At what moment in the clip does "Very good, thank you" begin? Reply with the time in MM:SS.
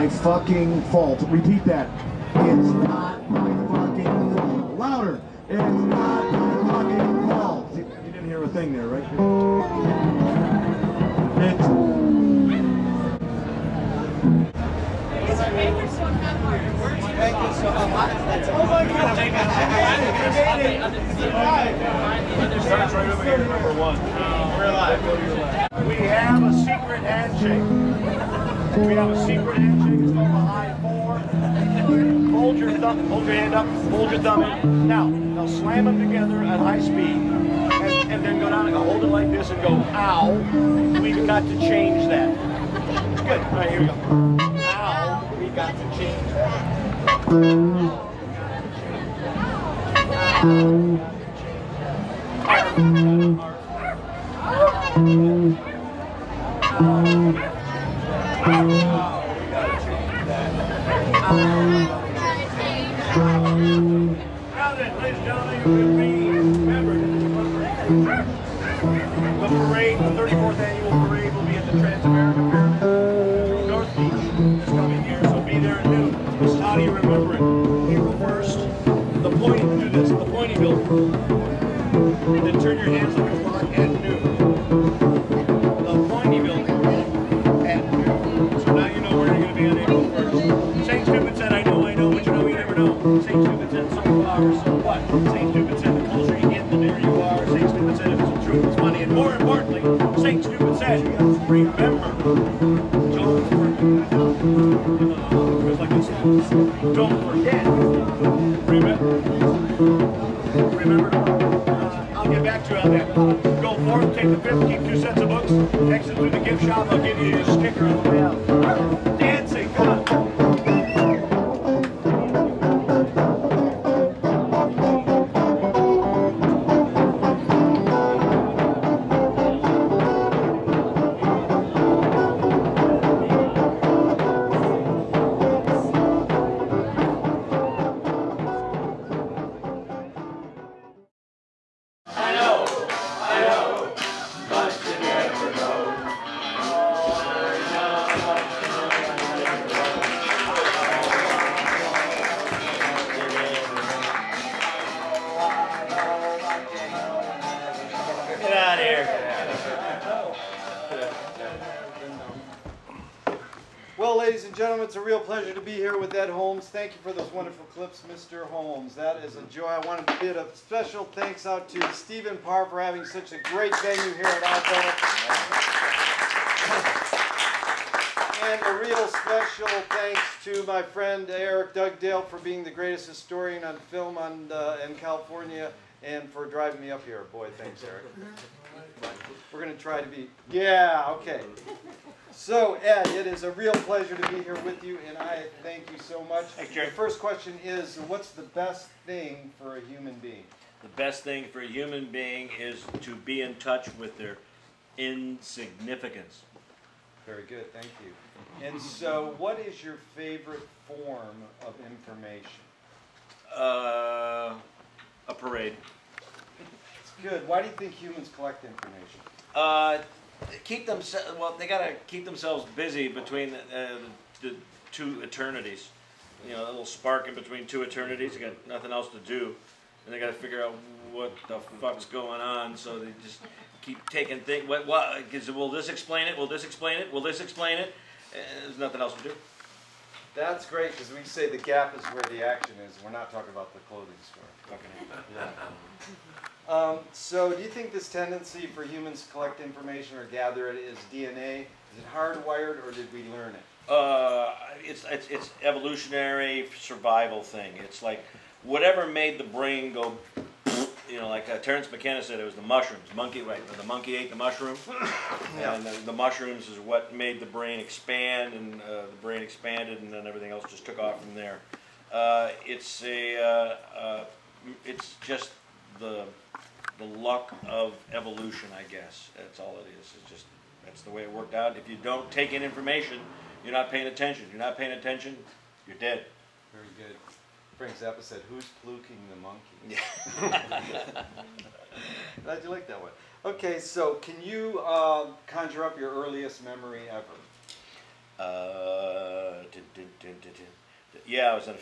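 03:27.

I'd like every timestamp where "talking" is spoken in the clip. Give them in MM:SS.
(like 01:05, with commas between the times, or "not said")
04:03.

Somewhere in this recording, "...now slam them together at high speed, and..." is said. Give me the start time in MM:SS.
00:35.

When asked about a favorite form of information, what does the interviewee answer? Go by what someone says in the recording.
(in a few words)
A parade.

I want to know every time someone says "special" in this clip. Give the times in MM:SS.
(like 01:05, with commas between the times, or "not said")
02:50, 02:59.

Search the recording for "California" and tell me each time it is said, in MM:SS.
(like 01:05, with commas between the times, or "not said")
03:04.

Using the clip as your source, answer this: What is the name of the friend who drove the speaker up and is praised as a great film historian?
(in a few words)
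Eric Dugdale.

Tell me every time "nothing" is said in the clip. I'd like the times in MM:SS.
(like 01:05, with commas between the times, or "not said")
03:48, 03:58.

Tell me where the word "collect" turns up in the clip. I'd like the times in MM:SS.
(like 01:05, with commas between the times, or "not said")
03:38, 04:09.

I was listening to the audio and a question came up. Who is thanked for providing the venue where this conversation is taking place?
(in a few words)
Stephen Parr.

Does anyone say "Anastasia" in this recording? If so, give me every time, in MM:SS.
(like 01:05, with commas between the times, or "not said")
not said.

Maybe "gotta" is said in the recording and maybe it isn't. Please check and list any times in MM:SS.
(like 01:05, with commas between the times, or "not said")
03:41, 03:50.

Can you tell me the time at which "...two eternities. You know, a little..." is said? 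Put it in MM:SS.
03:44.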